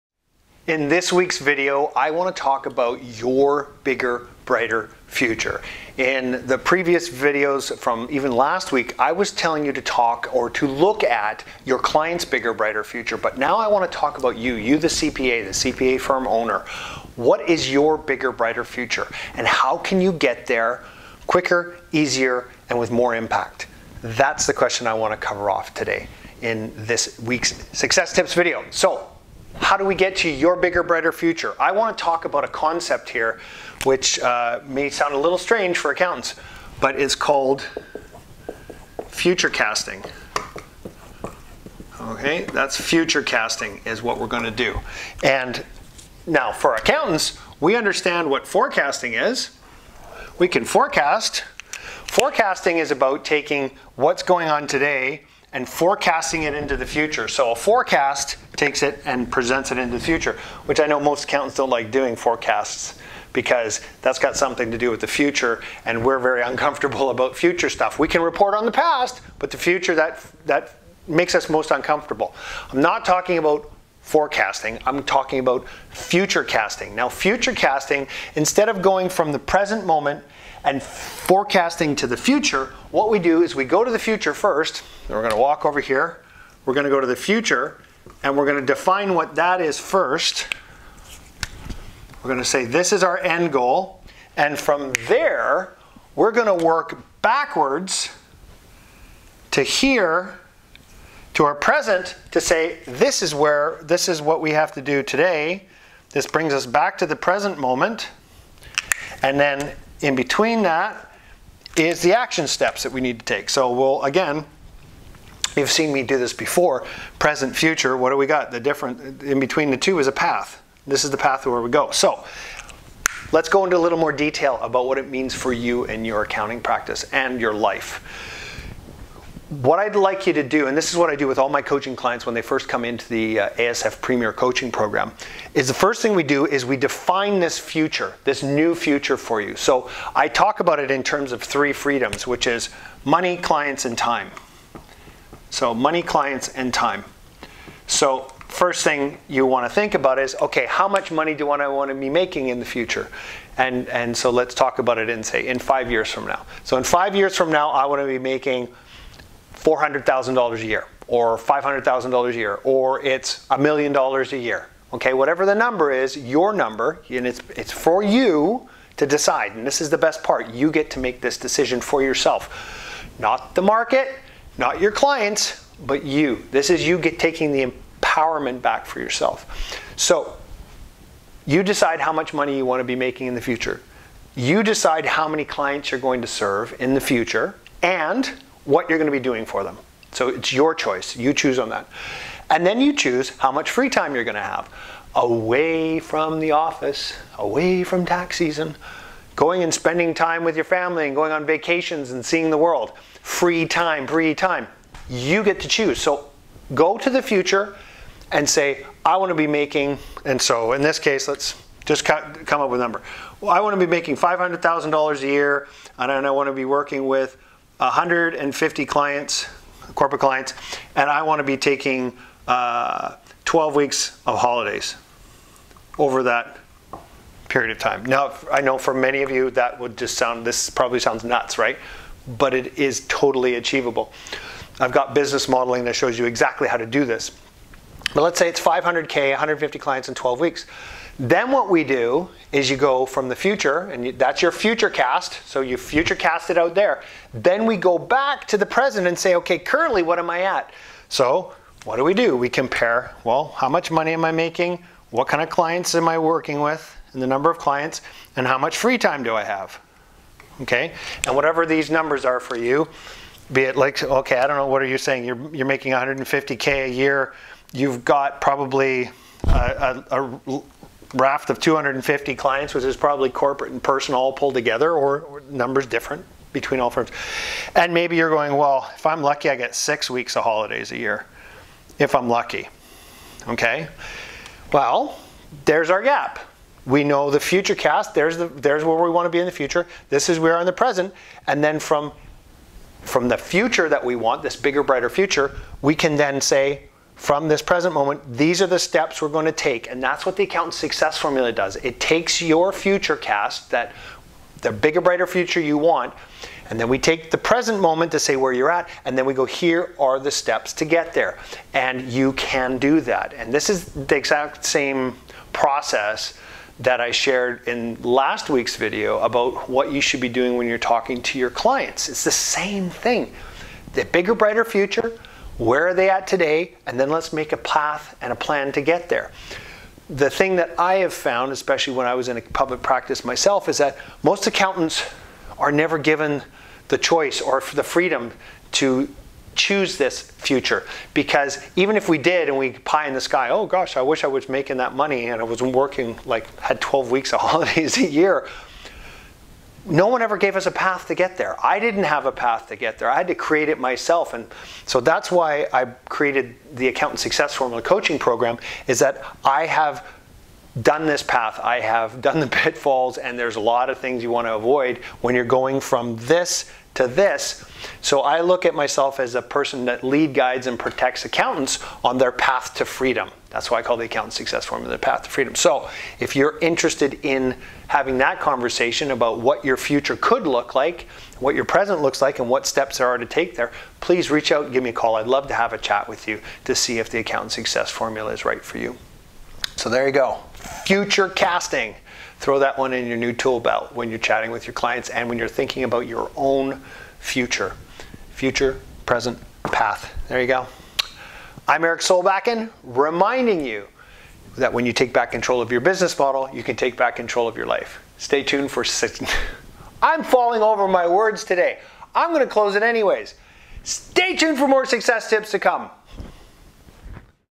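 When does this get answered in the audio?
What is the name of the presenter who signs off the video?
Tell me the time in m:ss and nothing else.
6:41.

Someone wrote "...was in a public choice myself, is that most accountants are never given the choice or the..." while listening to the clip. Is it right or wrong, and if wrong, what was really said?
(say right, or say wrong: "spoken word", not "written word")
wrong: "practice", not "choice".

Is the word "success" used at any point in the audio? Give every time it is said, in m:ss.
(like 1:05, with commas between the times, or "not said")
0:27, 5:00, 5:57, 6:14, 6:27, 6:54.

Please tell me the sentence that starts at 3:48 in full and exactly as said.
Now, I know for many of you that would just sound, this probably sounds nuts, right?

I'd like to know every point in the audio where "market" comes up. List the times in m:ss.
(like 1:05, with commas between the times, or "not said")
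2:53.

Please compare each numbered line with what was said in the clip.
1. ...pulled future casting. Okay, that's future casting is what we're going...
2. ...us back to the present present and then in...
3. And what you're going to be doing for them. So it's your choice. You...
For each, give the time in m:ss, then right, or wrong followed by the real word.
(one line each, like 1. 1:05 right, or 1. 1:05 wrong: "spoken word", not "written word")
1. 0:37 wrong: "called", not "pulled"
2. 1:46 wrong: "moment", not "present"
3. 3:07 right.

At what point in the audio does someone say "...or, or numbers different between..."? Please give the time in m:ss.
4:34.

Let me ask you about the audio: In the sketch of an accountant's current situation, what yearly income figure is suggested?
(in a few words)
150K.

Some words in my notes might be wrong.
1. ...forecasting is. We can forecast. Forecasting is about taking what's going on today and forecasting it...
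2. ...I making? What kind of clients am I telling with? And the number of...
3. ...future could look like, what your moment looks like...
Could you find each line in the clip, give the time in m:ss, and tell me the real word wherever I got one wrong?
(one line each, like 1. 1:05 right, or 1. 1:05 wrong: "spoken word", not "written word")
1. 0:48 right
2. 4:14 wrong: "working", not "telling"
3. 6:19 wrong: "present", not "moment".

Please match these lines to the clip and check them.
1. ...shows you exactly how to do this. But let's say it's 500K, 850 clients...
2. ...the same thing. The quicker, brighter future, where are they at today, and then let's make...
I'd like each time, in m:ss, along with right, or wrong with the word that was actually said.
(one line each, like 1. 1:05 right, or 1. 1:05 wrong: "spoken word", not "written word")
1. 3:55 wrong: "150", not "850"
2. 5:22 wrong: "bigger", not "quicker".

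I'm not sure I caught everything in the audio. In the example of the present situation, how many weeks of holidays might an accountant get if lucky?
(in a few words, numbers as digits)
6.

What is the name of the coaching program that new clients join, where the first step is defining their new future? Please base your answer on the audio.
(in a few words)
ASF Premier Coaching Program.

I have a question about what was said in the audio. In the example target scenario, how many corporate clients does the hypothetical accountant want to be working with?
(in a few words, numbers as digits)
150.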